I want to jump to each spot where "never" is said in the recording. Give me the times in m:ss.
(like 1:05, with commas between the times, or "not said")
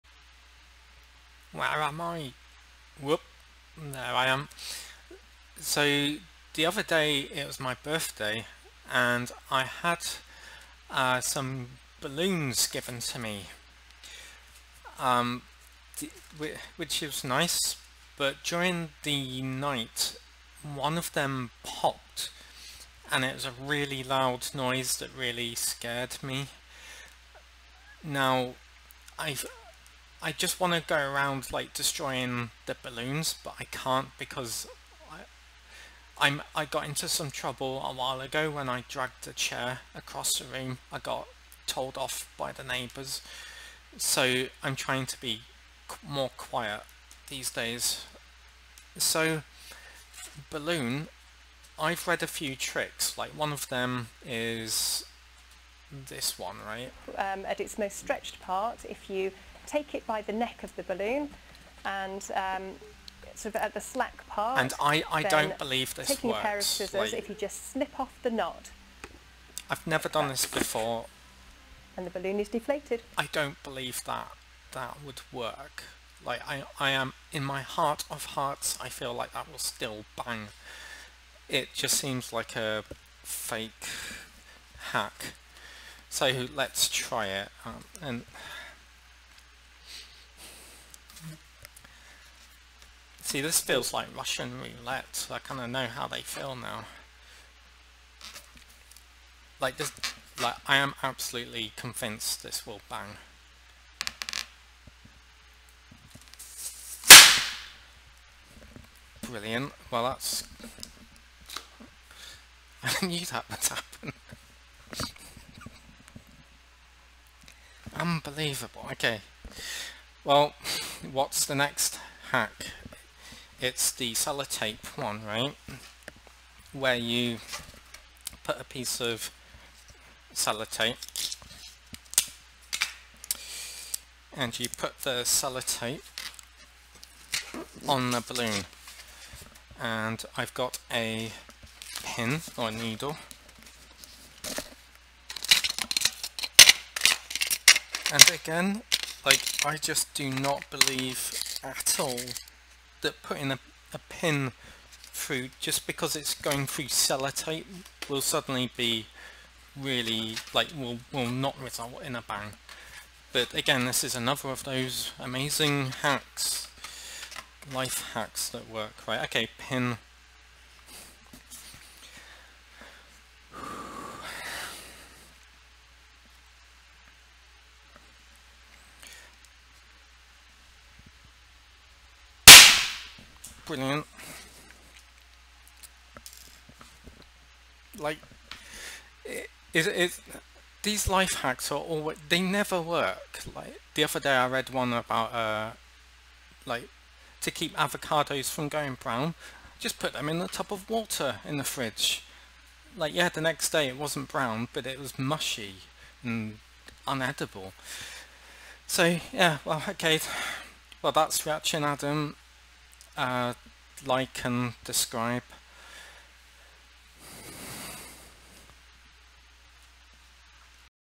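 1:09, 3:12.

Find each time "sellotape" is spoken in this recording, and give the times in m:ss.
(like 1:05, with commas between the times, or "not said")
2:04, 2:10, 2:15, 2:36.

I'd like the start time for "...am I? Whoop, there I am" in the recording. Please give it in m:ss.
0:01.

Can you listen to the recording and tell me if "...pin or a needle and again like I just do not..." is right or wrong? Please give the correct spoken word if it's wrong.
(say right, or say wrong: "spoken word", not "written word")
right.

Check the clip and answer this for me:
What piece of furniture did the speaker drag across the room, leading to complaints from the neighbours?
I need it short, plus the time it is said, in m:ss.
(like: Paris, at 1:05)
Chair, at 0:39.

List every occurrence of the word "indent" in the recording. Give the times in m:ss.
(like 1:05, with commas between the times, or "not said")
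not said.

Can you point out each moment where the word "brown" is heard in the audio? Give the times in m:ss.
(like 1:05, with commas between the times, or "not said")
3:19, 3:24.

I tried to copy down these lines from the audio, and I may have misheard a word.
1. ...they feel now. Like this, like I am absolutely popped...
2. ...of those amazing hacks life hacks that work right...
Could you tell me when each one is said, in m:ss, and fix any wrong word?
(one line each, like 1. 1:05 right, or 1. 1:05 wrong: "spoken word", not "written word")
1. 1:36 wrong: "convinced", not "popped"
2. 2:44 right.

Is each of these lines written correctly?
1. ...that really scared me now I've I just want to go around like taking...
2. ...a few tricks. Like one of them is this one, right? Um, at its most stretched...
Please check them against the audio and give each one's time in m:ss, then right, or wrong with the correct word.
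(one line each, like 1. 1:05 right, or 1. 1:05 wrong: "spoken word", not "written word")
1. 0:24 wrong: "destroying", not "taking"
2. 0:52 right.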